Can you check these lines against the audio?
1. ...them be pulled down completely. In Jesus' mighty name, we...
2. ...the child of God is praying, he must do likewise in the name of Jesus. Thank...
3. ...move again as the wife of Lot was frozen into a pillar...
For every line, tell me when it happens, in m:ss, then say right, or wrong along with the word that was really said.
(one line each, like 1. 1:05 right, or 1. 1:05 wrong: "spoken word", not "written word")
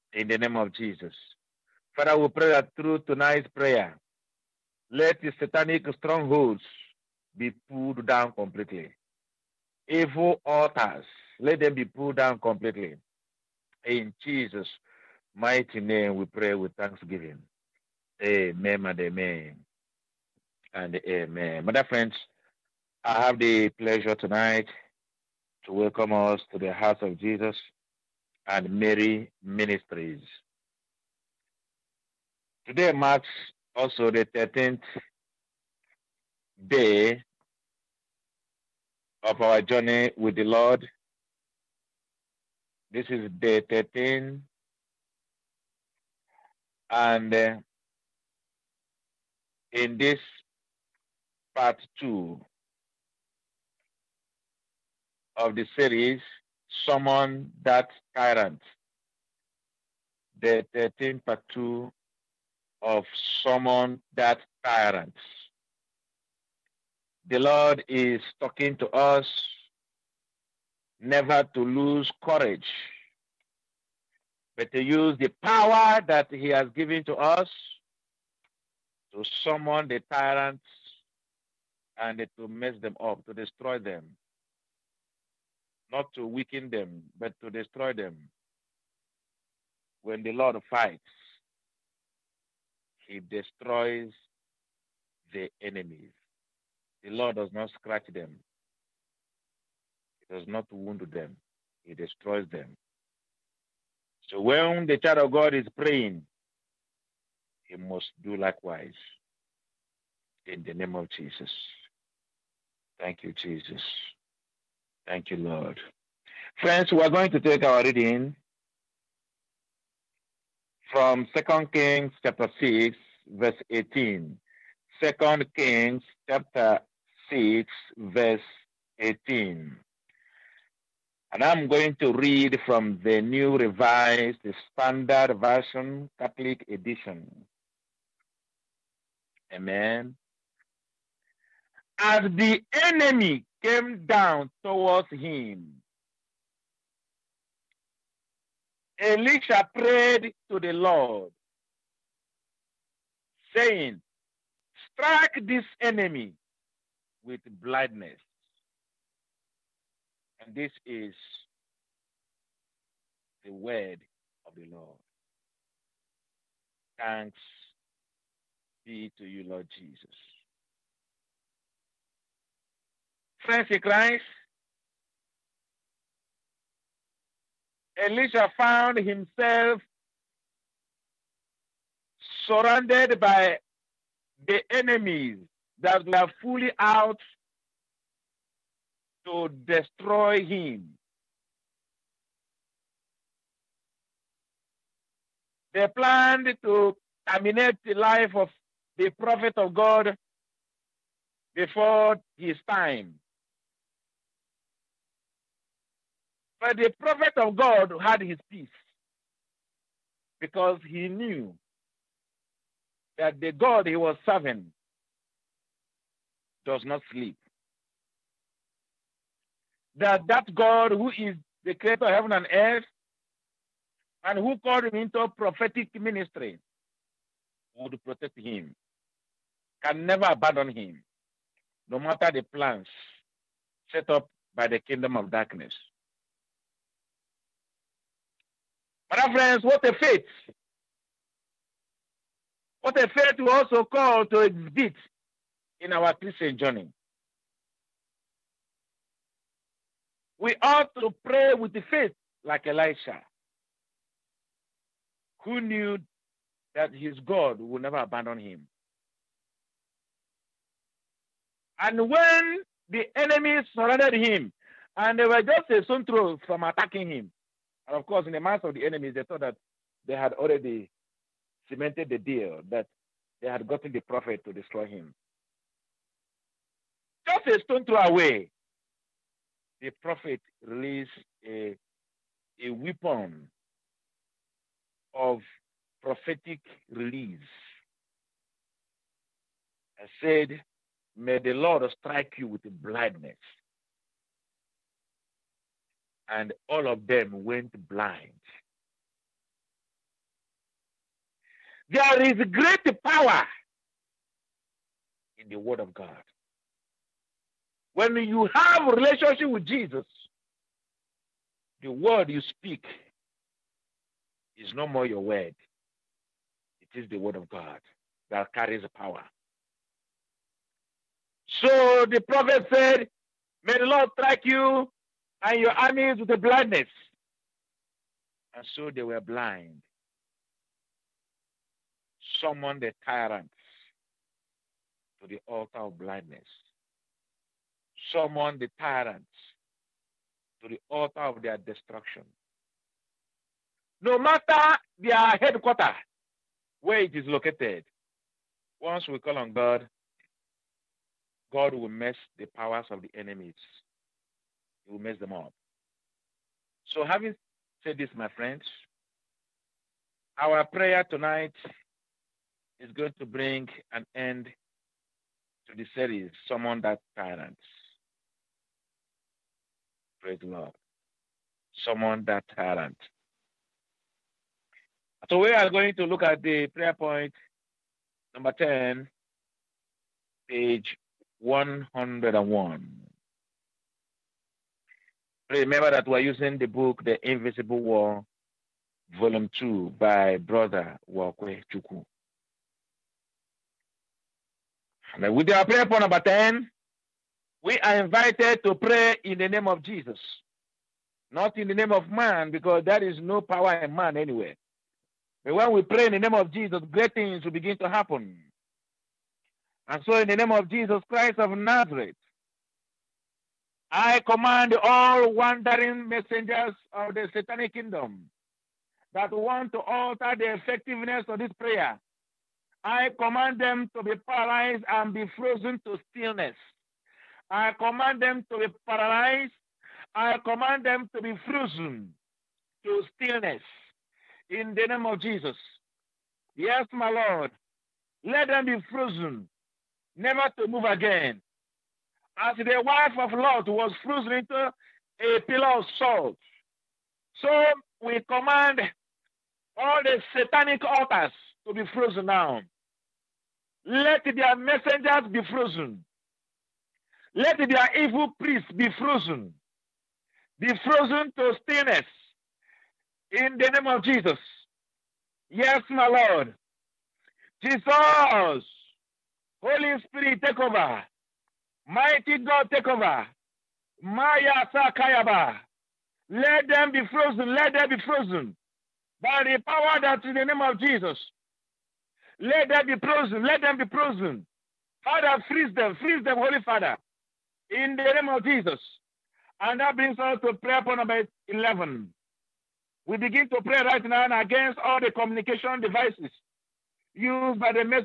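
1. 0:11 right
2. 1:44 right
3. 7:20 right.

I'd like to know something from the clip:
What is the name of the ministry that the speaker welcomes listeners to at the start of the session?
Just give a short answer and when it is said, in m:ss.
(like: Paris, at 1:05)
Hearts of Jesus and Mary Ministries, at 0:26.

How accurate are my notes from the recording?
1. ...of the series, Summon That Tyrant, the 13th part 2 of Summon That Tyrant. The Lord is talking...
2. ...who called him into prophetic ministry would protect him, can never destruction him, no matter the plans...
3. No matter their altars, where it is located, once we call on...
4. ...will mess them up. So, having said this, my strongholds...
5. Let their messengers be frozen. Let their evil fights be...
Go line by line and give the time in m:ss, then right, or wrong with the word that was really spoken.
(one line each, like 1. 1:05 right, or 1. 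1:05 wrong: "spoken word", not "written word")
1. 0:55 right
2. 3:44 wrong: "abandon", not "destruction"
3. 5:44 wrong: "headquarters", not "altars"
4. 5:54 wrong: "friends", not "strongholds"
5. 7:33 wrong: "priests", not "fights".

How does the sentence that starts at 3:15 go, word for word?
They planned to terminate the life of the prophet of God before his time.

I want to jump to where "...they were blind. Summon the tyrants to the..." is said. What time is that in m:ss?
5:28.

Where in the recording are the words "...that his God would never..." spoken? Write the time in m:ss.
4:16.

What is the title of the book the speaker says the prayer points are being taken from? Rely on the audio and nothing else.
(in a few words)
The Invisible War, Volume 2.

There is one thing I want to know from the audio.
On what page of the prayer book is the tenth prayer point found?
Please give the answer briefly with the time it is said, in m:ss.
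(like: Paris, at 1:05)
101, at 6:20.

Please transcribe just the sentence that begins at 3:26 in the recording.
But the prophet of God had his peace because he knew that the God he was serving does not sleep.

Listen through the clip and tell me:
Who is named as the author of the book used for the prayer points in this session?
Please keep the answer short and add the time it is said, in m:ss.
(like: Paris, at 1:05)
Brother Uwakwe Chukwu, at 6:30.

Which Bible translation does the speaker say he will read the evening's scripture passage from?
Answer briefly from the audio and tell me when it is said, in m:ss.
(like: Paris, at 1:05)
New Revised Standard Version, Catholic Edition, at 2:13.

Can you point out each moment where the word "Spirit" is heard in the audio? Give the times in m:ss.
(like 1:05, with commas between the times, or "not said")
7:50.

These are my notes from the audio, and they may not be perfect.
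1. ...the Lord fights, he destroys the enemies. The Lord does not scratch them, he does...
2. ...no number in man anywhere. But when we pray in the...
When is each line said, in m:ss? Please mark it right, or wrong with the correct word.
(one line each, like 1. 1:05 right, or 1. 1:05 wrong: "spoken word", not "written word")
1. 1:30 right
2. 6:43 wrong: "power", not "number".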